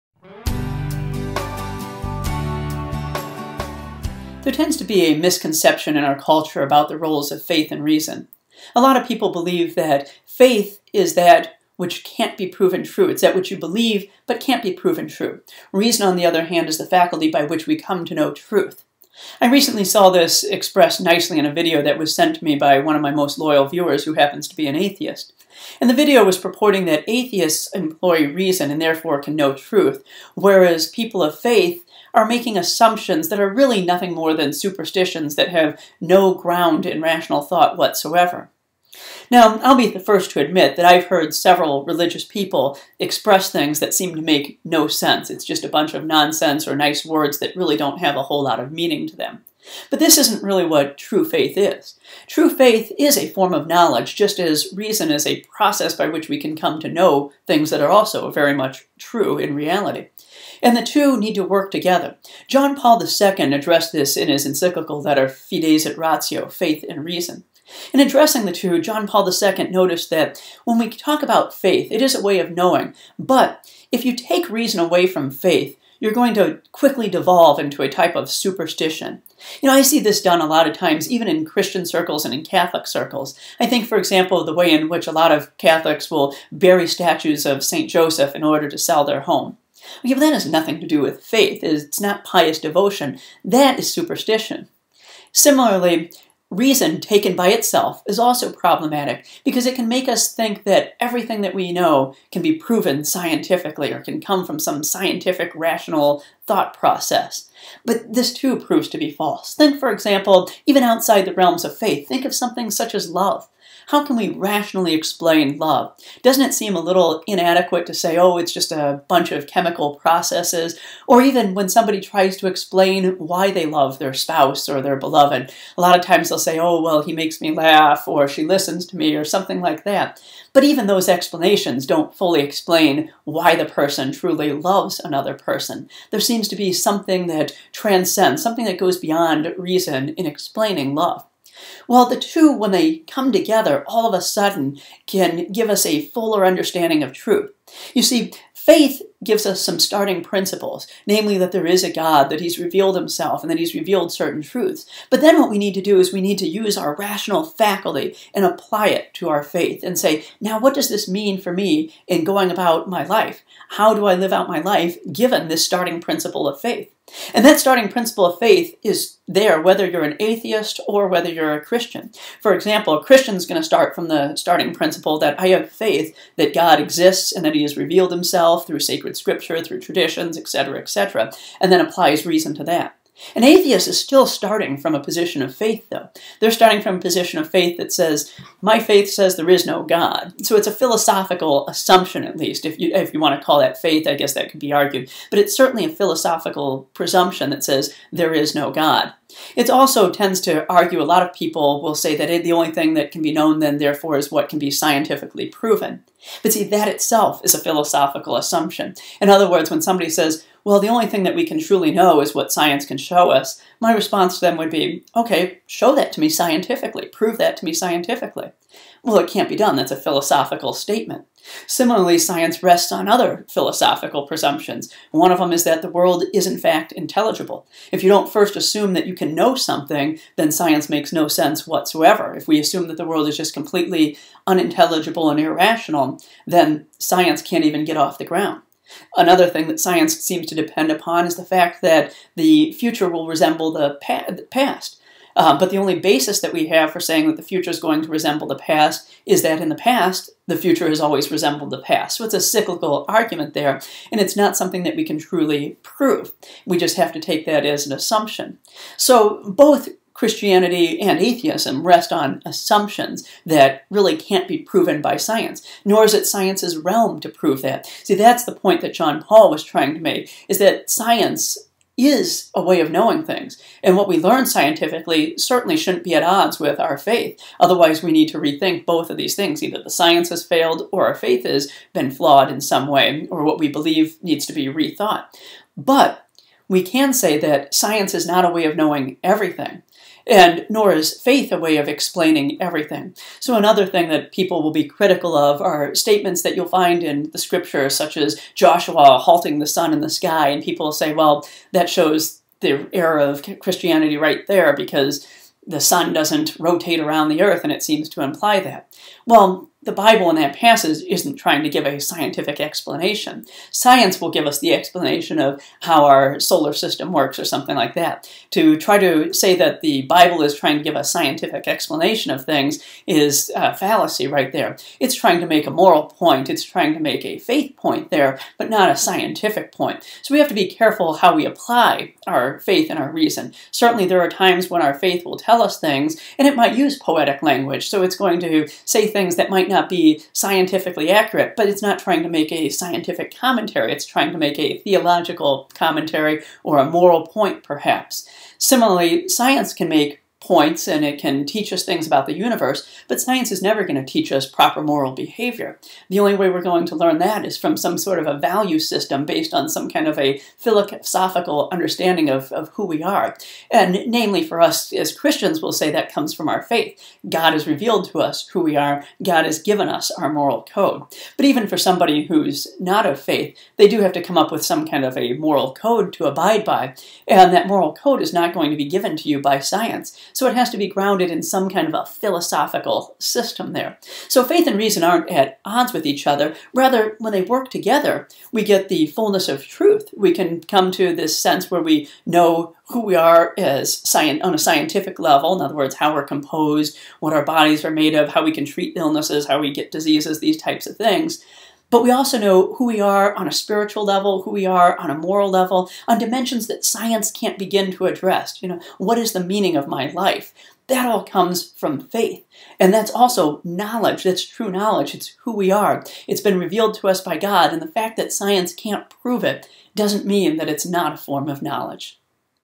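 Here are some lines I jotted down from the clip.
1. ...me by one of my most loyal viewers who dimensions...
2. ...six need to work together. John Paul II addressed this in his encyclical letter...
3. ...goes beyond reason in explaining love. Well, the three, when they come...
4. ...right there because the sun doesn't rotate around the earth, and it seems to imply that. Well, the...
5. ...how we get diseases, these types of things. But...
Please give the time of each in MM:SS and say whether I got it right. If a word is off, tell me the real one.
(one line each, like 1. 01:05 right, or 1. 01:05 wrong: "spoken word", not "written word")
1. 00:22 wrong: "happens", not "dimensions"
2. 01:00 wrong: "two", not "six"
3. 02:18 wrong: "two", not "three"
4. 05:04 right
5. 06:39 right.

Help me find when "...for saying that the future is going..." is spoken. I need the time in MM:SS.
04:06.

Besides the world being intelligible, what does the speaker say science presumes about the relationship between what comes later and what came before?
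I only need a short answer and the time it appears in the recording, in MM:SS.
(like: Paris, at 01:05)
The future will resemble the past, at 04:02.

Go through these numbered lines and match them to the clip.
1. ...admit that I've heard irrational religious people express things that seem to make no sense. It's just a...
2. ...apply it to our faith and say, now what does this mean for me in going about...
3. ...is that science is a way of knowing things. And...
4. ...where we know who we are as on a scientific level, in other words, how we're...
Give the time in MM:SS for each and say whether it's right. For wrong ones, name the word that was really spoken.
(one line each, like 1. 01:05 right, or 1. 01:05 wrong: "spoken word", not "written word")
1. 00:40 wrong: "several", not "irrational"
2. 02:38 right
3. 04:30 right
4. 06:31 right.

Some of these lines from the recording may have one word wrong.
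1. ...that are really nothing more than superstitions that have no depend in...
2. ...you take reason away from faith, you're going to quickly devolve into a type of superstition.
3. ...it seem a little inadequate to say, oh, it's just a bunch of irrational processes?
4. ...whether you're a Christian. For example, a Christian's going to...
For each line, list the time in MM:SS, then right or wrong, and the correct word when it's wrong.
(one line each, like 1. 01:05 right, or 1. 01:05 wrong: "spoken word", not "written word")
1. 00:33 wrong: "ground", not "depend"
2. 01:14 right
3. 01:56 wrong: "chemical", not "irrational"
4. 02:51 right.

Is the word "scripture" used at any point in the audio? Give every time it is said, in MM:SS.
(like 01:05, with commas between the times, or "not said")
02:59, 04:57.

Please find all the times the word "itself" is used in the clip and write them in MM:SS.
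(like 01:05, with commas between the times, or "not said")
01:37, 03:26.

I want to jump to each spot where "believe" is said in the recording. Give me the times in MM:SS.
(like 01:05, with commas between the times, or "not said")
00:09, 00:13, 04:43.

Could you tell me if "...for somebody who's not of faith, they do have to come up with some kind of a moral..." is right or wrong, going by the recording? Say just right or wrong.
right.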